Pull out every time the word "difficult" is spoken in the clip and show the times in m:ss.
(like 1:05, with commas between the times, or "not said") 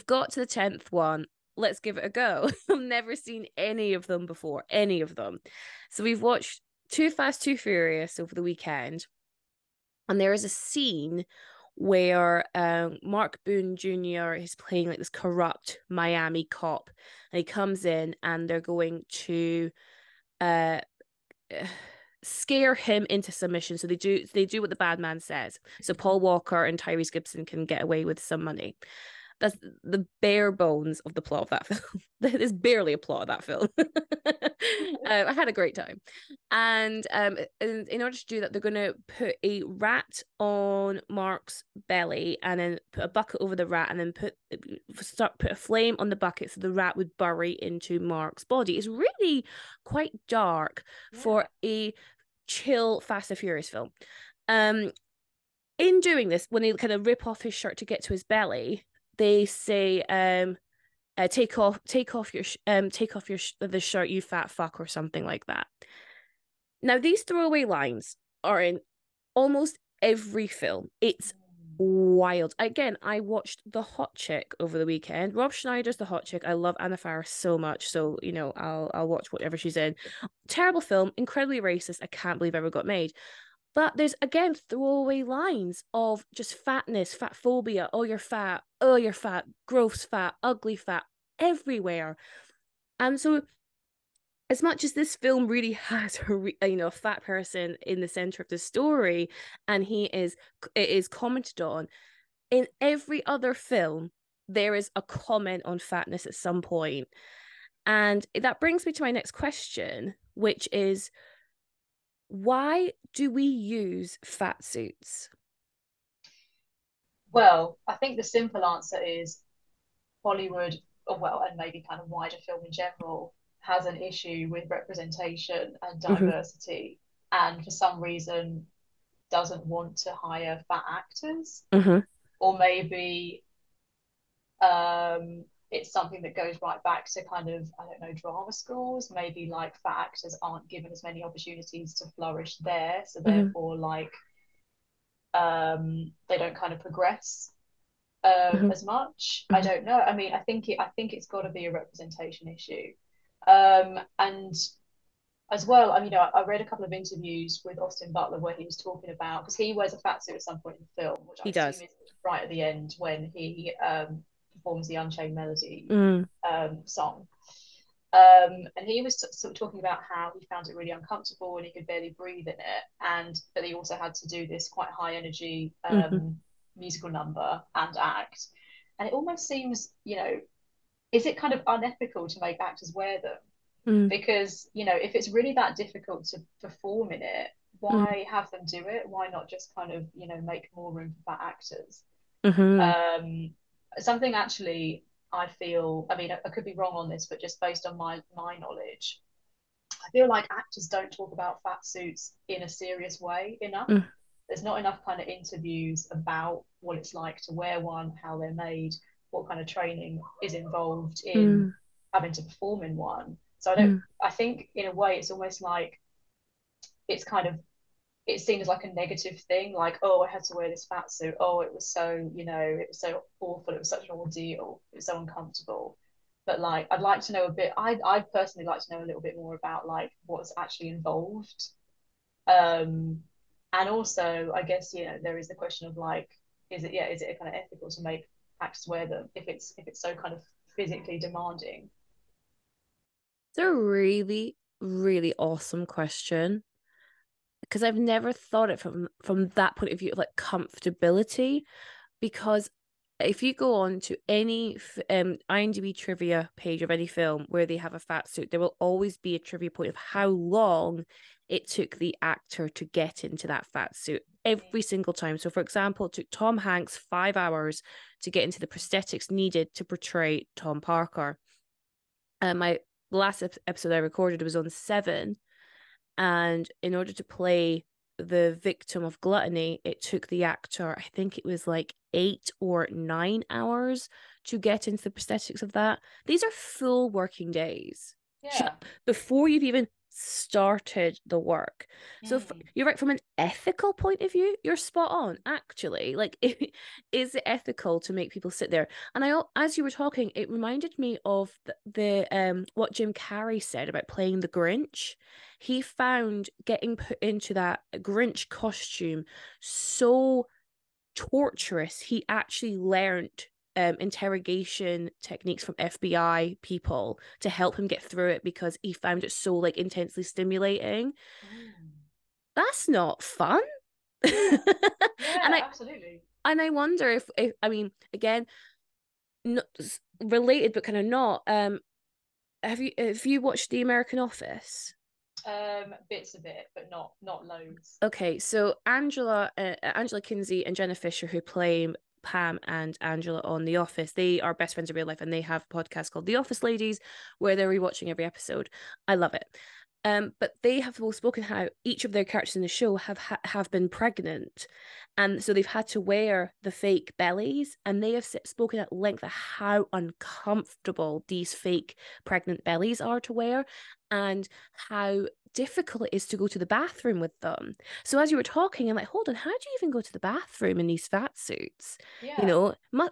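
3:05, 6:05.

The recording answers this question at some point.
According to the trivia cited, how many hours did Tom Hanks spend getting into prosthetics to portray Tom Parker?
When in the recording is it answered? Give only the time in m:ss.
4:26.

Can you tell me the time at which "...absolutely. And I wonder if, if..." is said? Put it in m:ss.
5:25.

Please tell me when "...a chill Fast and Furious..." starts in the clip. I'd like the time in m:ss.
0:51.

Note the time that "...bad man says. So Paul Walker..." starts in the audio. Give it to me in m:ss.
0:24.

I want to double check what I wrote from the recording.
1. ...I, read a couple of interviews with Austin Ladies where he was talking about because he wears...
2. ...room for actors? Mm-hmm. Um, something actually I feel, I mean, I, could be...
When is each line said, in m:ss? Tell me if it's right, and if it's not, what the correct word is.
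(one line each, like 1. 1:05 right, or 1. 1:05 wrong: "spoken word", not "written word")
1. 2:36 wrong: "Butler", not "Ladies"
2. 3:10 right.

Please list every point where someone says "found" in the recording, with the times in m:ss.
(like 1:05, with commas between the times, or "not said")
2:50, 5:05, 5:18.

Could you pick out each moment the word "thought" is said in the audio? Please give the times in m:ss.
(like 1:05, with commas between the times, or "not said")
4:08.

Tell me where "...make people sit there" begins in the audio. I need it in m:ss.
4:58.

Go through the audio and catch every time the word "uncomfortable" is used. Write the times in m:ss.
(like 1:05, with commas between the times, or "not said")
2:50, 3:45, 5:59.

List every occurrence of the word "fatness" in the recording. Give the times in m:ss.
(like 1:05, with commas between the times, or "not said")
1:26, 1:45.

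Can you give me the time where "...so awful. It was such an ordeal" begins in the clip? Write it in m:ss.
3:42.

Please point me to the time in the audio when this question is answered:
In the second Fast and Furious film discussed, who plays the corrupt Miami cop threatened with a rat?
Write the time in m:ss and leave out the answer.
0:13.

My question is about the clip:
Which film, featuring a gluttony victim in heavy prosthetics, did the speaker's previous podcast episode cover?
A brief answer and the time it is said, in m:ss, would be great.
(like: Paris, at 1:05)
Seven, at 4:34.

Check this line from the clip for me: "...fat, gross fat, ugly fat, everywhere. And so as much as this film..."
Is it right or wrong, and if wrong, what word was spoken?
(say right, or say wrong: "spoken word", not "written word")
right.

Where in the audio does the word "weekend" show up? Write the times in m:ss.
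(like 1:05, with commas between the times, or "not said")
0:08, 1:14.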